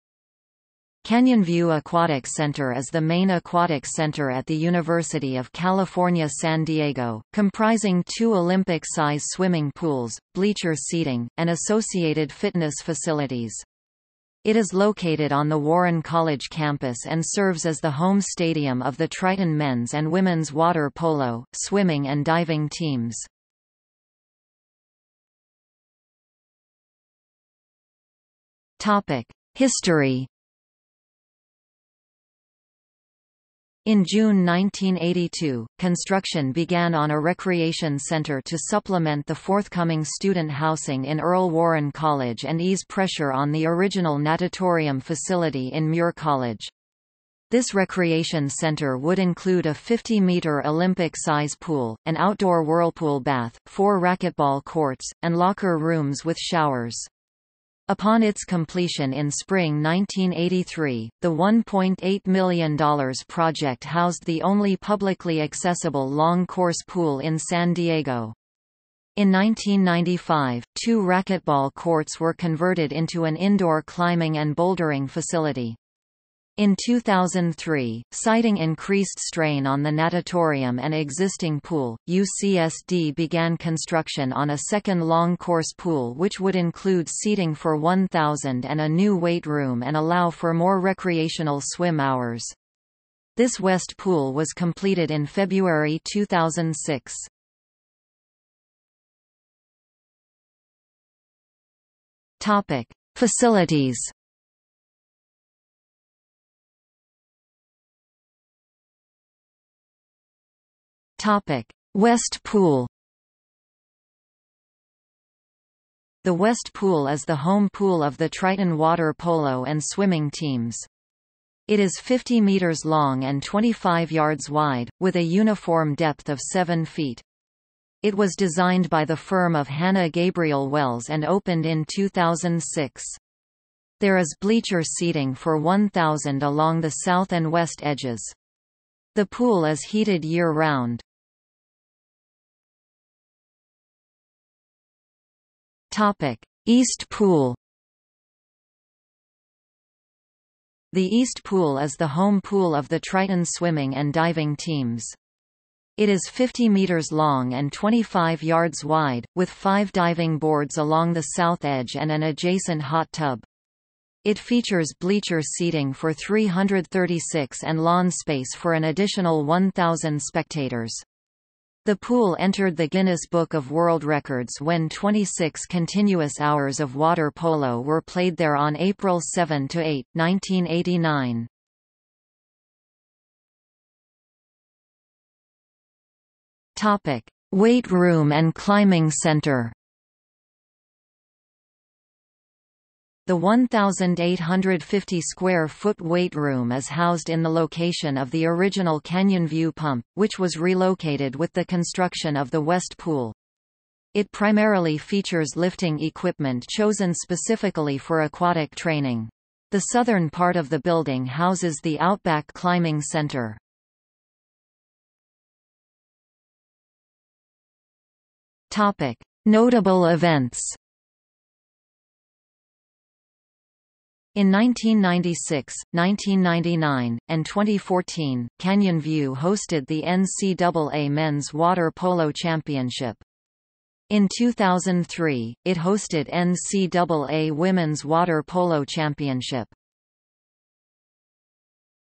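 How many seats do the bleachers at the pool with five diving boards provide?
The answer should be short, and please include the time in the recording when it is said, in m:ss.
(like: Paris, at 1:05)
336, at 2:46.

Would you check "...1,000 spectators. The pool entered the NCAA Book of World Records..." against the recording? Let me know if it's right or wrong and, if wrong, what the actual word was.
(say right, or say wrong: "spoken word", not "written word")
wrong: "Guinness", not "NCAA".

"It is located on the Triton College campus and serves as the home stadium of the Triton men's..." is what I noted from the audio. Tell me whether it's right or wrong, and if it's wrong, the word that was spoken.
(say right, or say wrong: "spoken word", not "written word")
wrong: "Warren", not "Triton".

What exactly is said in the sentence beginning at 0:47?
This recreation center would include a 50-meter Olympic-size pool, an outdoor whirlpool bath, four racquetball courts, and locker rooms with showers.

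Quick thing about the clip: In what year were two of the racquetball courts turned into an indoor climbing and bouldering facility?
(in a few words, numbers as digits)
1995.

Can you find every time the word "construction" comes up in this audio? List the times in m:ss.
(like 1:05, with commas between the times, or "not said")
0:35, 1:23, 3:21.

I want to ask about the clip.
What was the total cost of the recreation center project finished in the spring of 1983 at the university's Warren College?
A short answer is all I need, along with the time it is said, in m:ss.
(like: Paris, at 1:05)
$1.8 million, at 1:01.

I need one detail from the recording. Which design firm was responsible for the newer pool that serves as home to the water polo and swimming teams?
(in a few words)
Hanna Gabriel Wells.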